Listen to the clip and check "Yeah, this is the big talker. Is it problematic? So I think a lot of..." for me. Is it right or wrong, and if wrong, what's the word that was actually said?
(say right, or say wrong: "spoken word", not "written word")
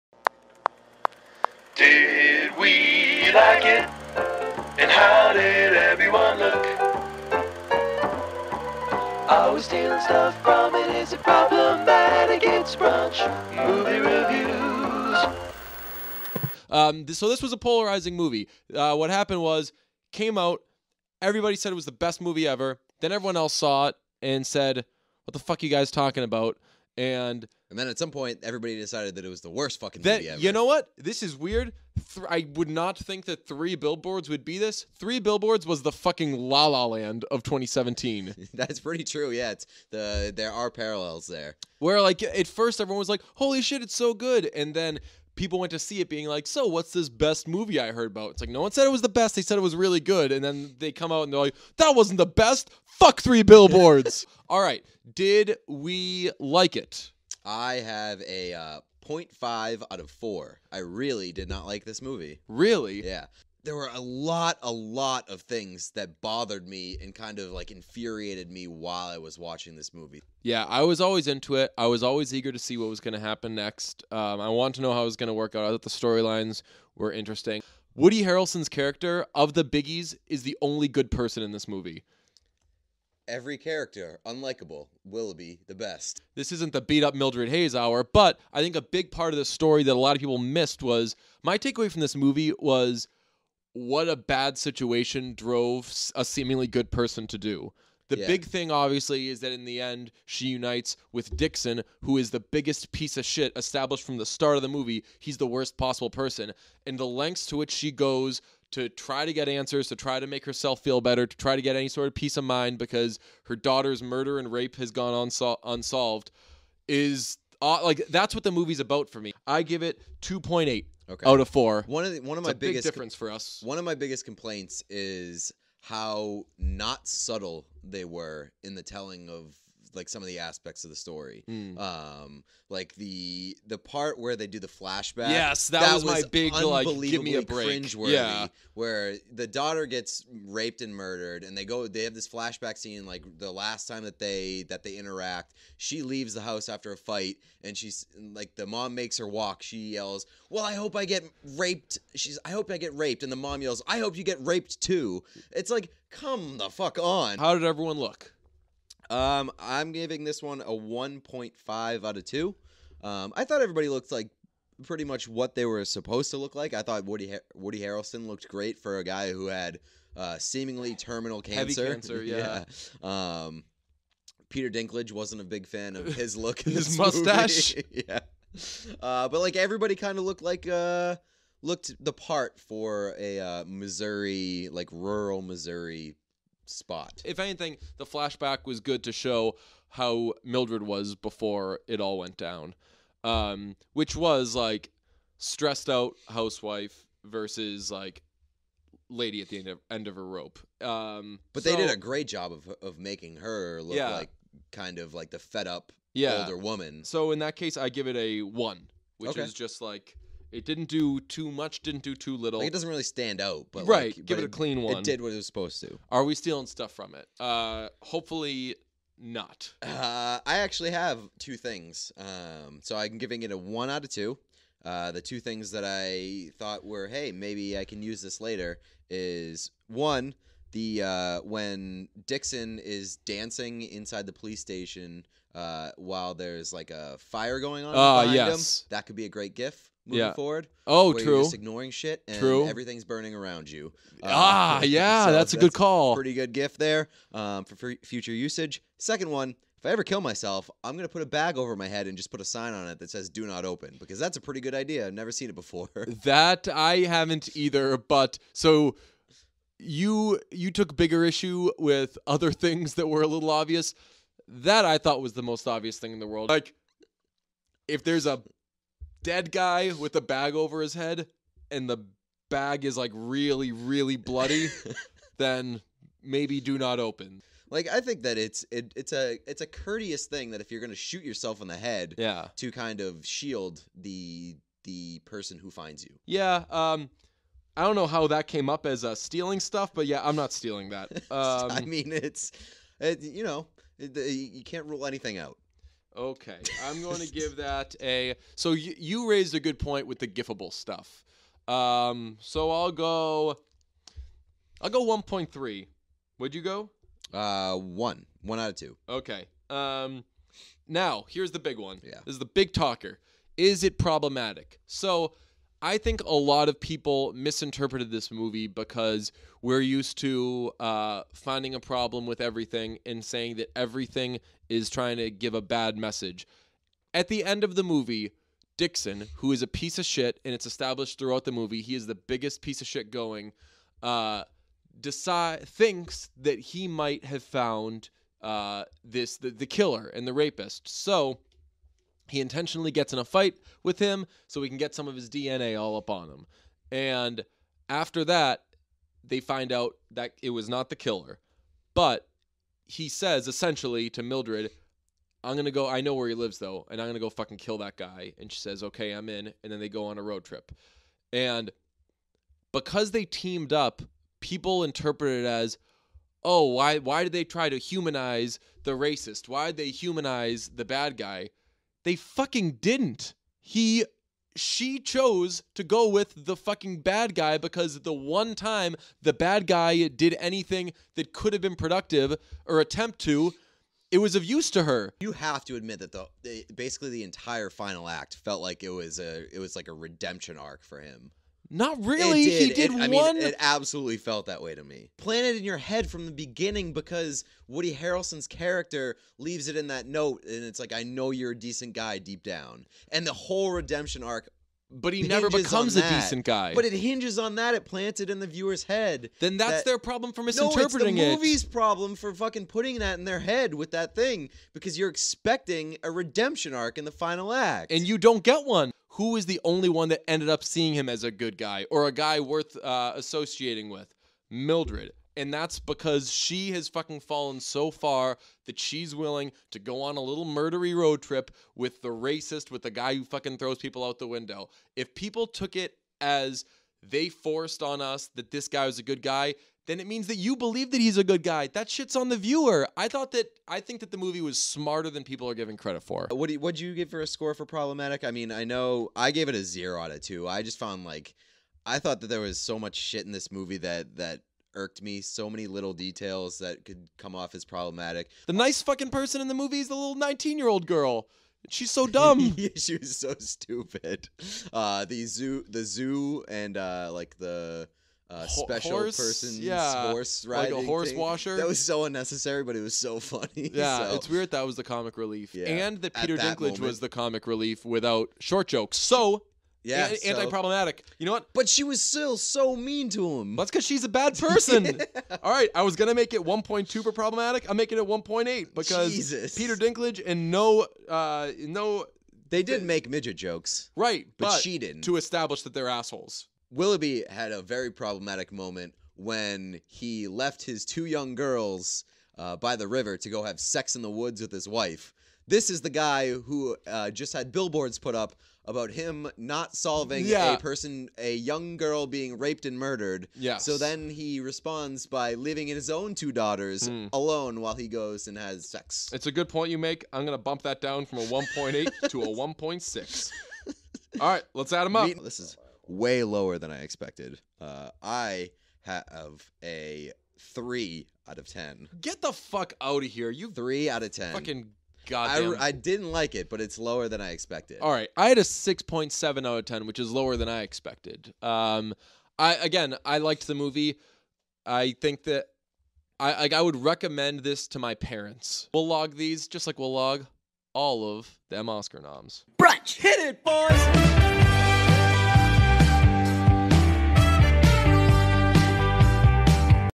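right.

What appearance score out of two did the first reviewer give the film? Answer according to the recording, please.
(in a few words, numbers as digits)
1.5.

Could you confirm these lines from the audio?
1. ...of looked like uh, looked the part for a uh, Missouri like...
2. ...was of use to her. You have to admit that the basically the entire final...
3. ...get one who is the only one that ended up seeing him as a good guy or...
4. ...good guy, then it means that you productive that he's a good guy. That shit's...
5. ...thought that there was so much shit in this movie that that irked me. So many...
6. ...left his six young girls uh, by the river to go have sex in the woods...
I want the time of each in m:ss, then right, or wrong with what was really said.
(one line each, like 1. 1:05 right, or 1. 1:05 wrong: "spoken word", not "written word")
1. 3:00 right
2. 6:24 right
3. 6:58 right
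4. 7:19 wrong: "believe", not "productive"
5. 7:31 right
6. 8:20 wrong: "two", not "six".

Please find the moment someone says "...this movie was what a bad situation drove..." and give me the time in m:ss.
1:32.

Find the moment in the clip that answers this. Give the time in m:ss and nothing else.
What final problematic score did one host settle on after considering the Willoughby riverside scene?
8:42.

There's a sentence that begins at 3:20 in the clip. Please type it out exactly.
Um, but so, they did a great job of of making her look yeah.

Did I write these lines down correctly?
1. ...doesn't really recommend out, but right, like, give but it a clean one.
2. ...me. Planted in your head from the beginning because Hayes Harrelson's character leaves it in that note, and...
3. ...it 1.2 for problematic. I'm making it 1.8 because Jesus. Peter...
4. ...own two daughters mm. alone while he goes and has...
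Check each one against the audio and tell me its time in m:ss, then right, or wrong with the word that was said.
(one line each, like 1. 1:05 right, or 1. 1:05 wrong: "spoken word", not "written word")
1. 3:32 wrong: "stand", not "recommend"
2. 6:34 wrong: "Woody", not "Hayes"
3. 8:06 right
4. 8:35 right.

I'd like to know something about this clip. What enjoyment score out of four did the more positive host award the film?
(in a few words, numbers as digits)
2.8.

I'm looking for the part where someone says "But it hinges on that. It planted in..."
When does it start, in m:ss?
6:46.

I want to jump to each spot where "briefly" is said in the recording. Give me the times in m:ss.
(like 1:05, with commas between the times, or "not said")
not said.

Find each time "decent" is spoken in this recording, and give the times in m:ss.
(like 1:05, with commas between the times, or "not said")
6:41, 6:46.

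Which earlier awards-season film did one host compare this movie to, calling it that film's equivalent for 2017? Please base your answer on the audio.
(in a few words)
La La Land.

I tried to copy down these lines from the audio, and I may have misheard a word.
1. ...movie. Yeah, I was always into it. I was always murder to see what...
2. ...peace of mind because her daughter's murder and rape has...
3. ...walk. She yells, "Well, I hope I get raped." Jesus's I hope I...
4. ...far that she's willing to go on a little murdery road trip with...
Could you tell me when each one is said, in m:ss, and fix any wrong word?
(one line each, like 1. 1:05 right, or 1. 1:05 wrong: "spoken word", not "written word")
1. 1:09 wrong: "eager", not "murder"
2. 1:52 right
3. 2:29 wrong: "She", not "Jesus"
4. 7:07 right.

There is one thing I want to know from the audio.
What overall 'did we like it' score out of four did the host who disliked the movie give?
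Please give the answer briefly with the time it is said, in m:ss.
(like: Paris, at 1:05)
0.5, at 0:59.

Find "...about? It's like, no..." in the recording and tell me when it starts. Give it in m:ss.
0:48.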